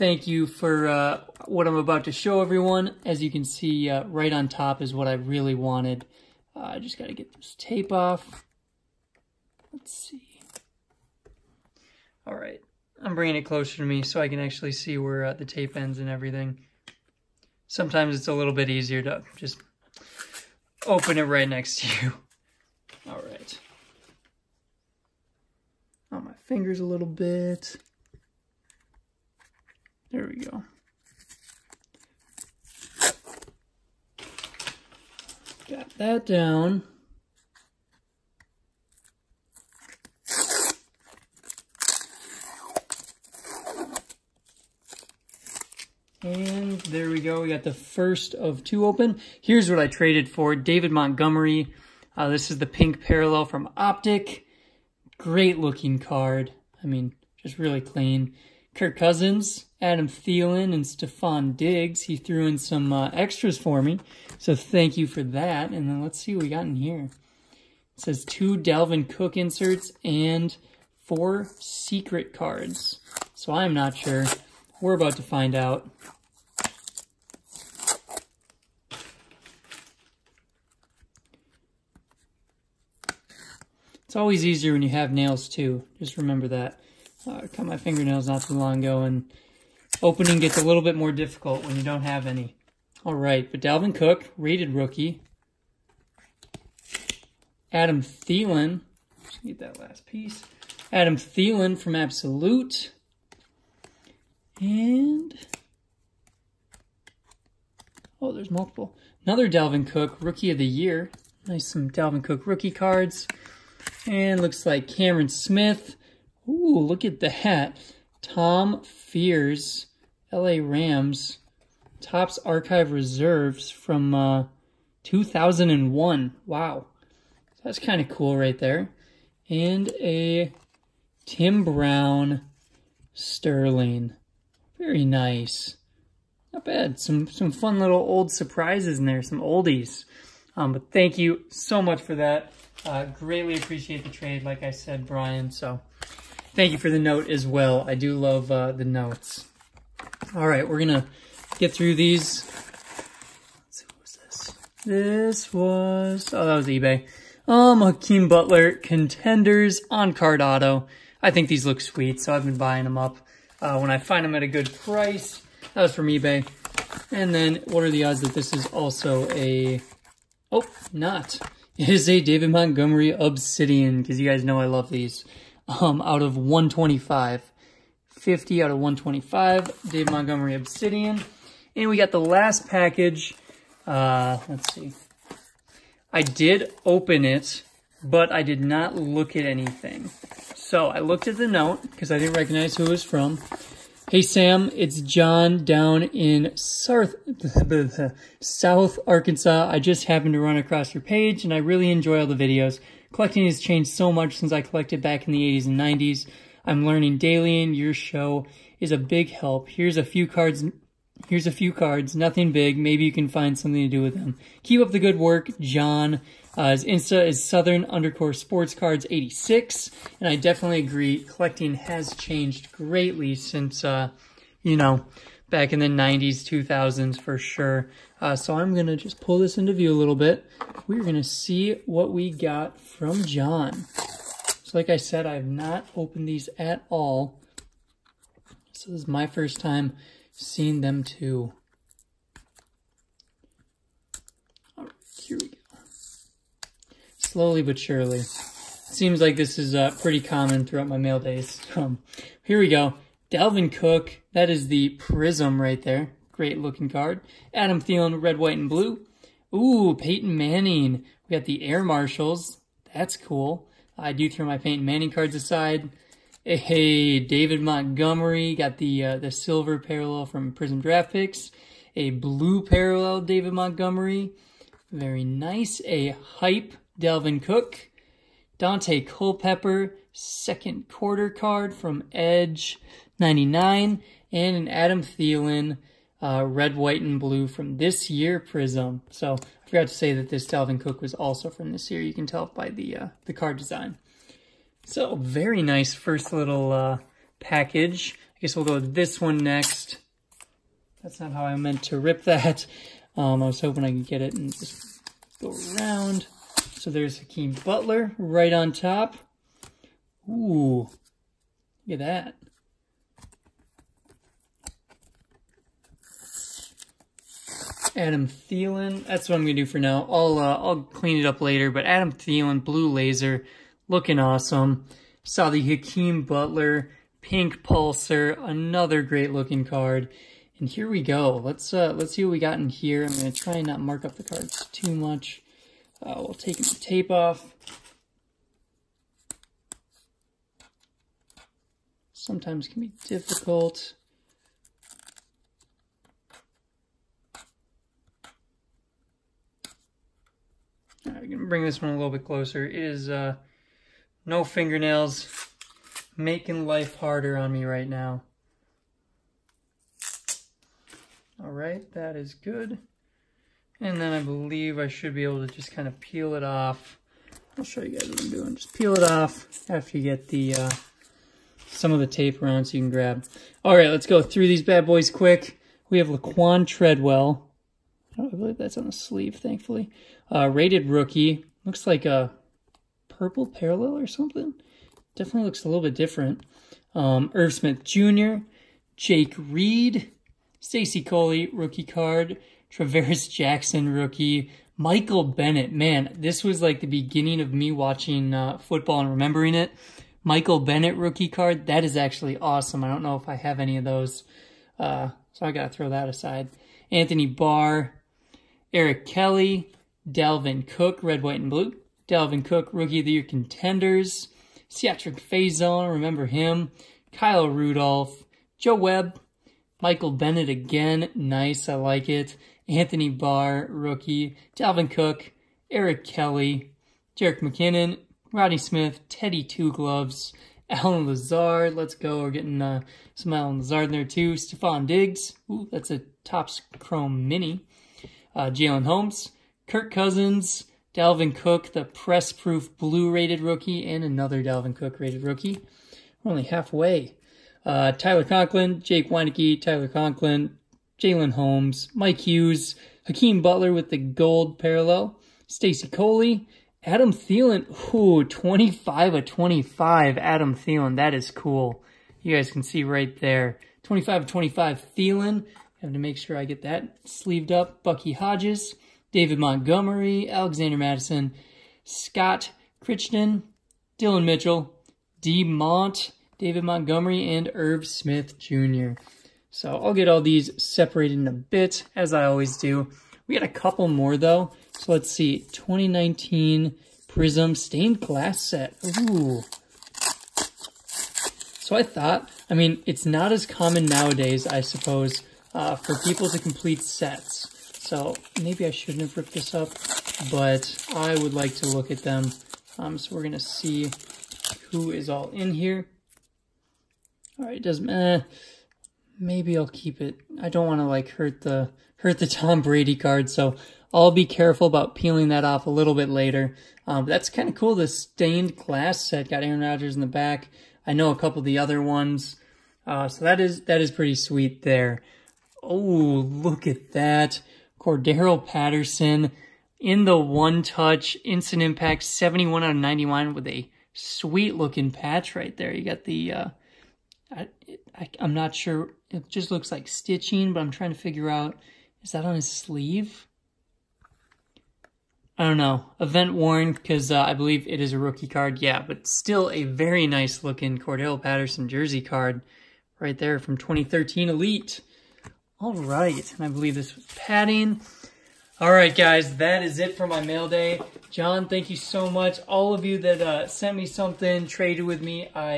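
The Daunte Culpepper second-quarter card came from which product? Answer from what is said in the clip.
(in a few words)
Edge 99.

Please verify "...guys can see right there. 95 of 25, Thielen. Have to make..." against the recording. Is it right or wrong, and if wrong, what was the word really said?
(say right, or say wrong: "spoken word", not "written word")
wrong: "25", not "95".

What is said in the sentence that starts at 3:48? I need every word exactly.
Uh, so I'm going to just pull this into view a little bit.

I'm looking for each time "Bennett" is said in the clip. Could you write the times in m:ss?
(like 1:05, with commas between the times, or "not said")
6:35, 6:40, 7:00.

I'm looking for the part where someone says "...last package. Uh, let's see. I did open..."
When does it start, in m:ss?
3:02.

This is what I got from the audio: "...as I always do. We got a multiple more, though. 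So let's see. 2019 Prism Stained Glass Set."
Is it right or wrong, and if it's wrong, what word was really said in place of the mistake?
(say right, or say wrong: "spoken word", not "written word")
wrong: "couple", not "multiple".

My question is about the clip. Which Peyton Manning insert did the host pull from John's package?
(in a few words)
Air Marshals.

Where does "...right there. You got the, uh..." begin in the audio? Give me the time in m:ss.
8:55.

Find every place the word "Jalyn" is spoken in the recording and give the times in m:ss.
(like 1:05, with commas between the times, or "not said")
7:18, 7:30.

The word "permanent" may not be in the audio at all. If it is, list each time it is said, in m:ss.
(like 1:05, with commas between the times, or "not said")
not said.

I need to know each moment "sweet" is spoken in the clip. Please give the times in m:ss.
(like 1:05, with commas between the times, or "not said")
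2:41, 8:44, 8:53.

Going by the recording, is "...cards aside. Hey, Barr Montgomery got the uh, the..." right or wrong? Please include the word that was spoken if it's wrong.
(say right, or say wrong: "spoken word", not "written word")
wrong: "David", not "Barr".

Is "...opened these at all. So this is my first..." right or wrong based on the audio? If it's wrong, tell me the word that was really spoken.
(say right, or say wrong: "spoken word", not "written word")
right.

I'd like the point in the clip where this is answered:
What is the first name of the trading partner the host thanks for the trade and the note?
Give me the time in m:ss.
2:25.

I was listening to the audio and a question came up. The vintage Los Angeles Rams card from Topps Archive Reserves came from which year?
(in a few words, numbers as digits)
2001.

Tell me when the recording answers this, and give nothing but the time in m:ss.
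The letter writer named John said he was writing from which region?
3:18.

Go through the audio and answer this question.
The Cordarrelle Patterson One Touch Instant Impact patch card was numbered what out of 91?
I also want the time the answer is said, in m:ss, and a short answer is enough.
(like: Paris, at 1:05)
71, at 8:52.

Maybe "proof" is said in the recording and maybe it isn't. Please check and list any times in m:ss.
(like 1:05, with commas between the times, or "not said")
7:22.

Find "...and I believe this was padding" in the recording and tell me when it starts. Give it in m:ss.
9:16.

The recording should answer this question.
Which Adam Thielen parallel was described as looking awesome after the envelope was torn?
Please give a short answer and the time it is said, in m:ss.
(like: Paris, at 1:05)
Blue Laser, at 5:22.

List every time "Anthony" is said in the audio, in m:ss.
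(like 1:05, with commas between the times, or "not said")
6:46, 7:02.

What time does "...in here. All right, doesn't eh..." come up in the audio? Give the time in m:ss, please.
8:25.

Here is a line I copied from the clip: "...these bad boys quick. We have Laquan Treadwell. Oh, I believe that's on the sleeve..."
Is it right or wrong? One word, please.
right.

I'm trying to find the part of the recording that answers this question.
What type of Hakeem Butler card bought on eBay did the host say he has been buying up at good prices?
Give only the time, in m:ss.
2:38.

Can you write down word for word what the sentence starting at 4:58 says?
I guess we'll go with this one next.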